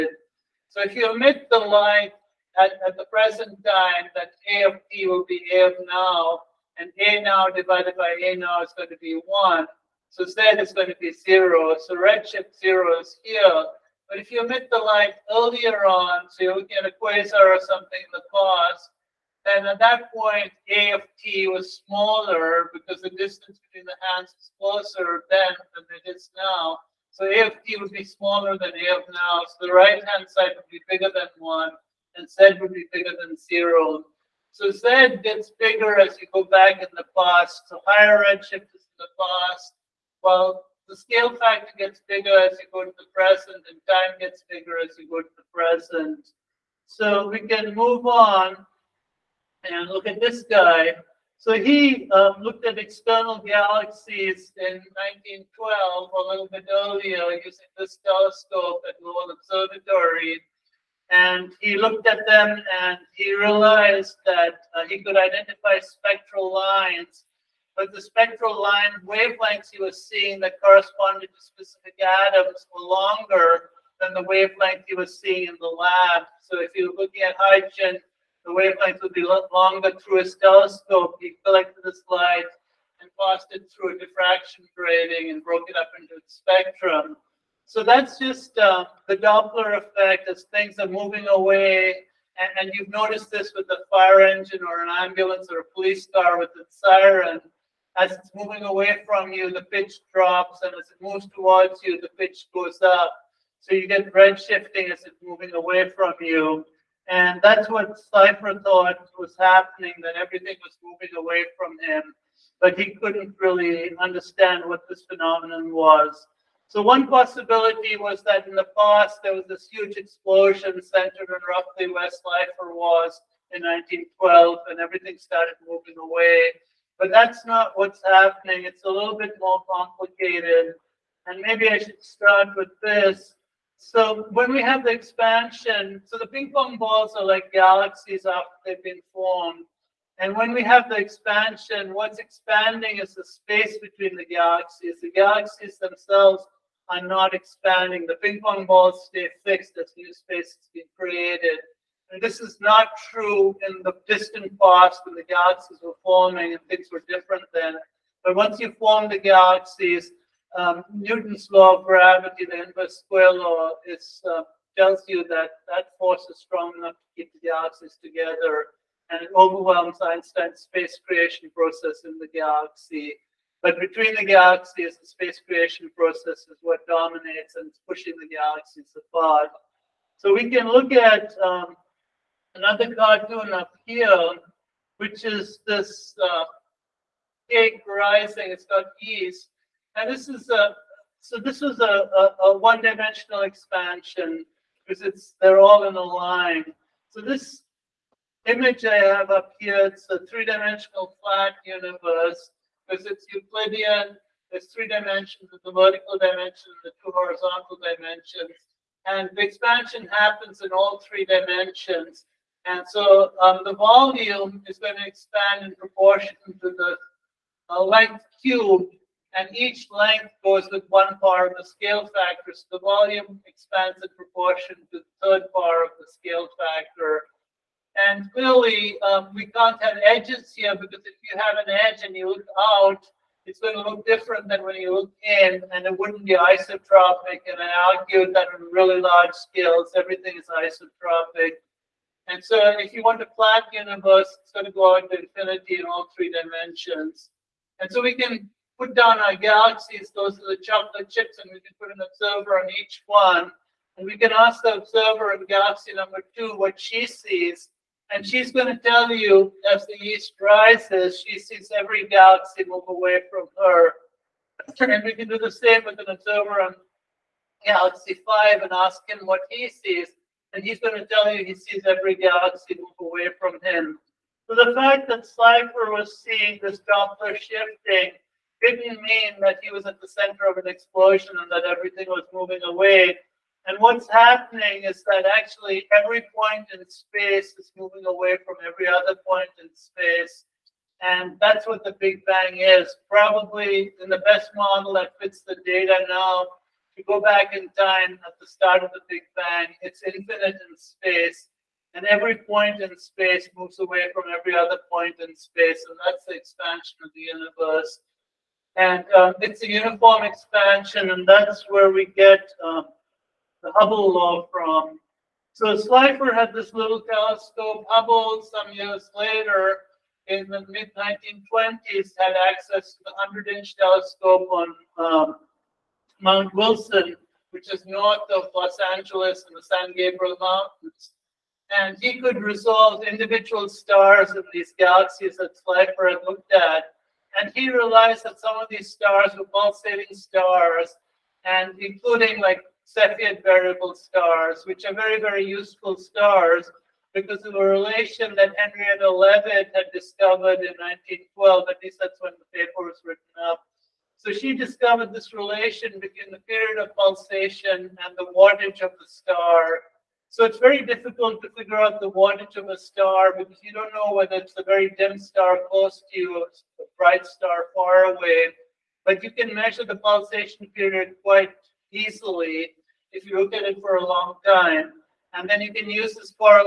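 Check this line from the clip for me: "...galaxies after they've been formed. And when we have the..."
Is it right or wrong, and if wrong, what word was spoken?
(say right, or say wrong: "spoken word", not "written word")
right.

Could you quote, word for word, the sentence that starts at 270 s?
And he's going to tell you he sees every galaxy move away from him.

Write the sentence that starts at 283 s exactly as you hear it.
And what's happening is that actually every point in space is moving away from every other point in space.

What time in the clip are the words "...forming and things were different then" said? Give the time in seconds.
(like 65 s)
156 s.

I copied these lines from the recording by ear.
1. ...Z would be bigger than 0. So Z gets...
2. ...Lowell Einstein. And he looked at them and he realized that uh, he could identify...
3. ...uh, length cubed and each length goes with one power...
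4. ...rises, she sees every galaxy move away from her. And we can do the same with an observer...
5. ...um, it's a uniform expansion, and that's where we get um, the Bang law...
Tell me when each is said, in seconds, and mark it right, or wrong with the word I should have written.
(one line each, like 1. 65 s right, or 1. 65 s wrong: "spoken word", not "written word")
1. 32 s right
2. 59 s wrong: "Observatory", not "Einstein"
3. 217 s right
4. 260 s right
5. 309 s wrong: "Hubble", not "Bang".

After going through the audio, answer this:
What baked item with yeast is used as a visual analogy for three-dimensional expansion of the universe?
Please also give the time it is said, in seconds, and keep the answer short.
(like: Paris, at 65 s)
Cake, at 187 s.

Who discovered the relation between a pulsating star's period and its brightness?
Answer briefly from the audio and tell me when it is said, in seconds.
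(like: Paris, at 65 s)
Henrietta Leavitt, at 348 s.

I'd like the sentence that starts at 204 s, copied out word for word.
There's three dimensions, the vertical dimension, the two horizontal dimensions.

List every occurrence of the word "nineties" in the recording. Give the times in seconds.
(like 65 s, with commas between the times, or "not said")
not said.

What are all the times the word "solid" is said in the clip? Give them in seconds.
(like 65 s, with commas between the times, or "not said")
not said.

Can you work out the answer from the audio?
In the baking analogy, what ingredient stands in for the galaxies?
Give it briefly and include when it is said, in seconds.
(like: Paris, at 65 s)
Chocolate chips, at 250 s.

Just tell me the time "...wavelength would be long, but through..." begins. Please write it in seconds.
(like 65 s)
78 s.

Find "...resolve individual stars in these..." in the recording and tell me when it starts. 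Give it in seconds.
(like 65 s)
332 s.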